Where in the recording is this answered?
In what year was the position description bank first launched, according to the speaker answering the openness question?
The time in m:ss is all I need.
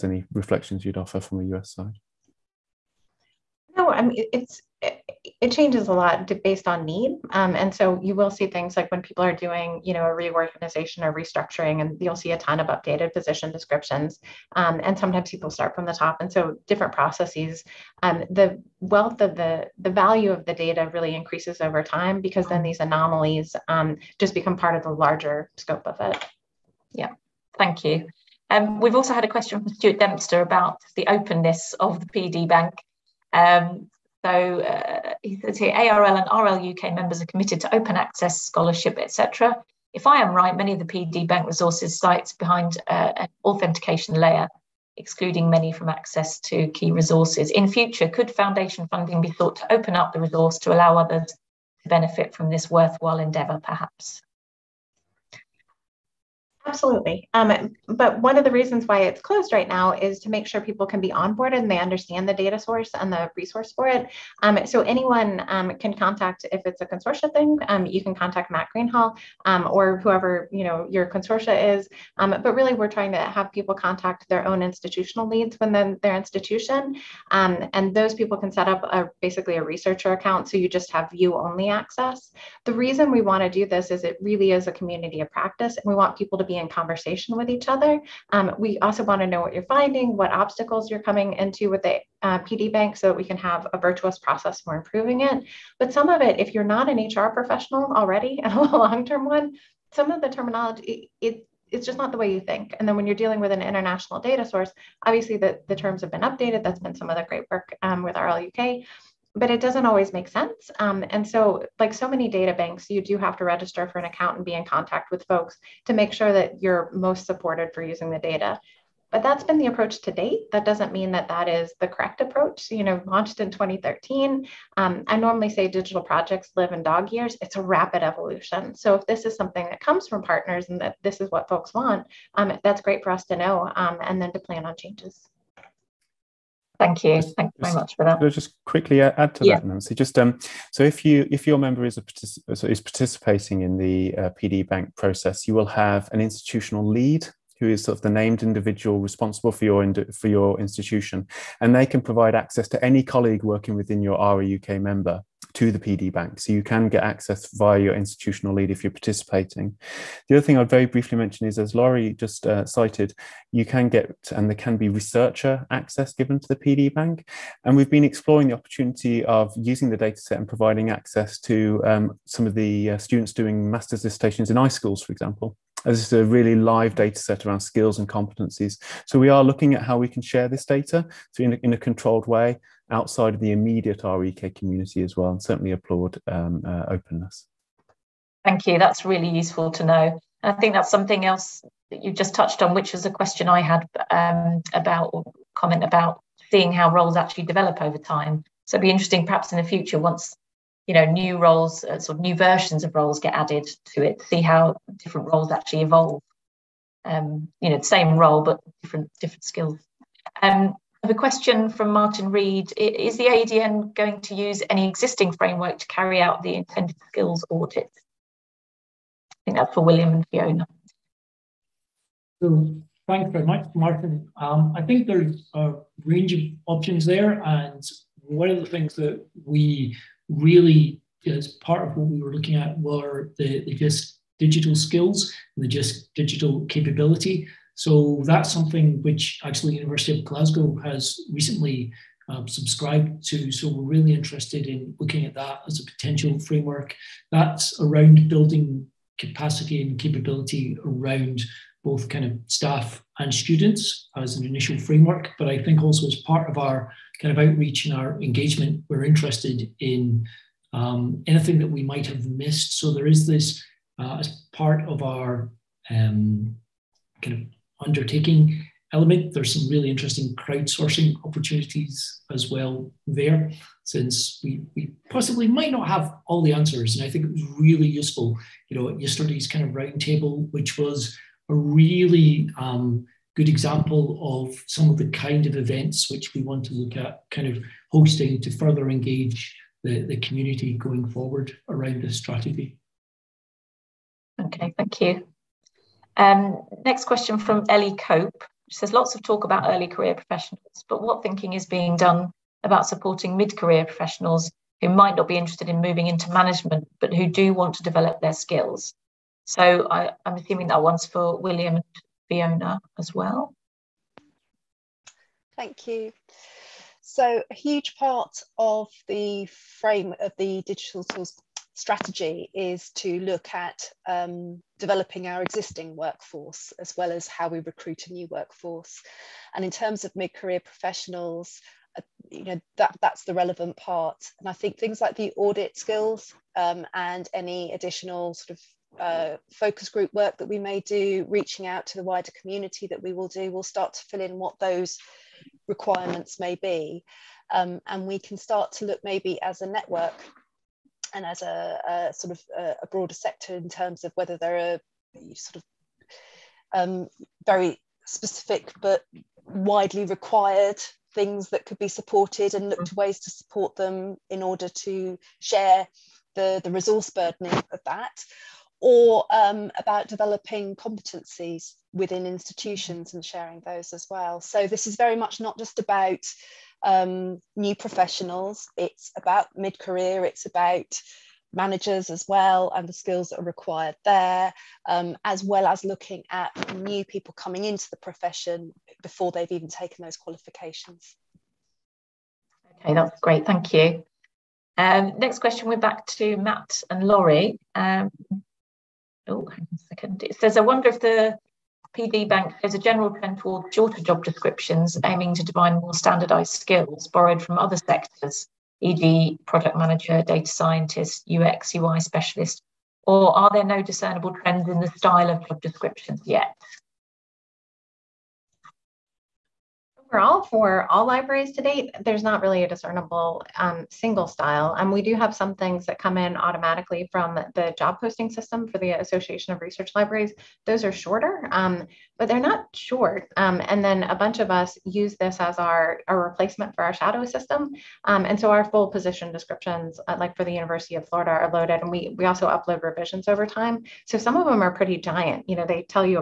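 2:03.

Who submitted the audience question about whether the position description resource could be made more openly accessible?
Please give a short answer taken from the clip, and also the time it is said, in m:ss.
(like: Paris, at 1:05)
Stuart Dempster, at 0:29.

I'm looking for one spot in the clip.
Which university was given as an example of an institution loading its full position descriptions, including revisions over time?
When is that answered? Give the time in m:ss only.
7:20.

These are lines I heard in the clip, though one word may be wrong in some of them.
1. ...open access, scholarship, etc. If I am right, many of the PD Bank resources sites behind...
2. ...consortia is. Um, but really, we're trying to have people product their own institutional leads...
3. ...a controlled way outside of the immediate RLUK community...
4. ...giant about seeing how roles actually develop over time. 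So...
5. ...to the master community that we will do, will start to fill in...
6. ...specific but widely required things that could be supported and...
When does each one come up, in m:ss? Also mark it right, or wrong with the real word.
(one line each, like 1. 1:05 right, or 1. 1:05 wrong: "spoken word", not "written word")
1. 0:37 right
2. 1:11 wrong: "contact", not "product"
3. 3:01 right
4. 3:15 wrong: "comment", not "giant"
5. 5:41 wrong: "wider", not "master"
6. 5:58 right.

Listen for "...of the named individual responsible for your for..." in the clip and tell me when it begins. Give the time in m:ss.
2:27.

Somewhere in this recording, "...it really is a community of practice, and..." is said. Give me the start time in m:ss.
1:24.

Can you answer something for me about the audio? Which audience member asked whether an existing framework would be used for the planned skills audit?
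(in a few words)
Martin Reed.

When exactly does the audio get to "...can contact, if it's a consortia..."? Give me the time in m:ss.
1:05.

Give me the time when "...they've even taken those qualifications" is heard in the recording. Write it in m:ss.
6:29.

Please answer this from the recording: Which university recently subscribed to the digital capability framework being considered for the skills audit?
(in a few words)
University of Glasgow.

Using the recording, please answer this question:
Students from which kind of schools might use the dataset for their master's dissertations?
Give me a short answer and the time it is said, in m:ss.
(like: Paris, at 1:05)
iSchools, at 2:54.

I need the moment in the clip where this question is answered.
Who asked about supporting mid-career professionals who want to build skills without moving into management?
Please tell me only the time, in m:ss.
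4:57.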